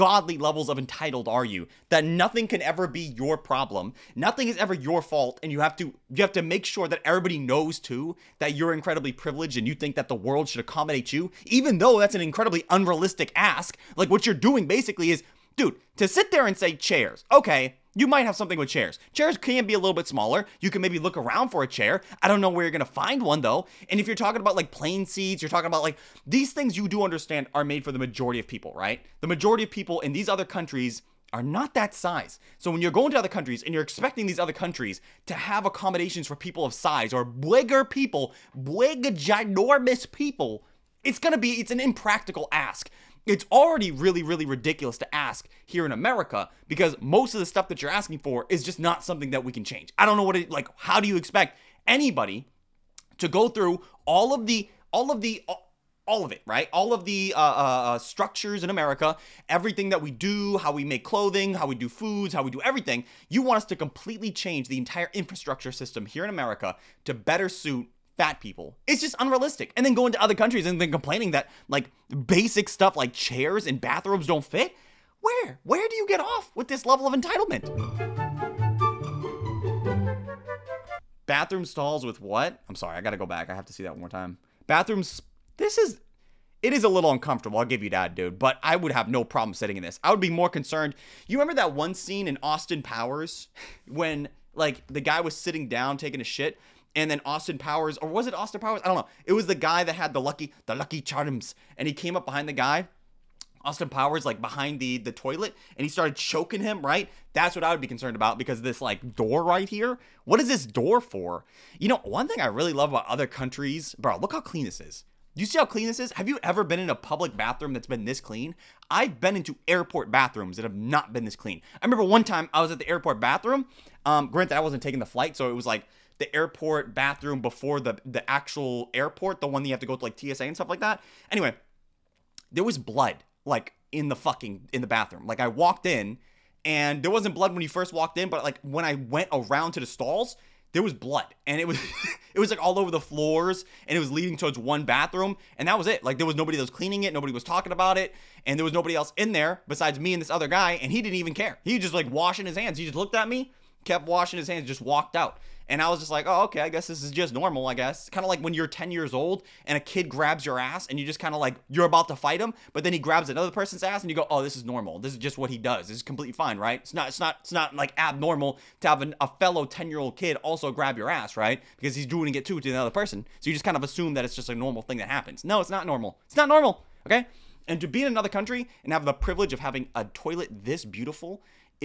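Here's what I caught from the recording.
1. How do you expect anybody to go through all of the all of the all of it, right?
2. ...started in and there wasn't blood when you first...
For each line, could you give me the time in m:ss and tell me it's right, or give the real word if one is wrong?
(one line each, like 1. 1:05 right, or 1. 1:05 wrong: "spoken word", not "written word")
1. 0:50 right
2. 2:15 wrong: "walked", not "started".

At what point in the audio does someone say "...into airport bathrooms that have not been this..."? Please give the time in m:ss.
1:59.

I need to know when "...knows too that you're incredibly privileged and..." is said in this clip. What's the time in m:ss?
0:07.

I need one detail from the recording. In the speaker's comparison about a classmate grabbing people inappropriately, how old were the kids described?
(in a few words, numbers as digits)
10.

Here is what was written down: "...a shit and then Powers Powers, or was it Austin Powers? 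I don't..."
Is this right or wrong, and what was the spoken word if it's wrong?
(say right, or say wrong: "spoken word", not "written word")
wrong: "Austin", not "Powers".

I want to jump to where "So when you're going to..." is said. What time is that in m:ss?
0:32.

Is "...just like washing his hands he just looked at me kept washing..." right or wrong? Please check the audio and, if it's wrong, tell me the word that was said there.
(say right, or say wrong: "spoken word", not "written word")
right.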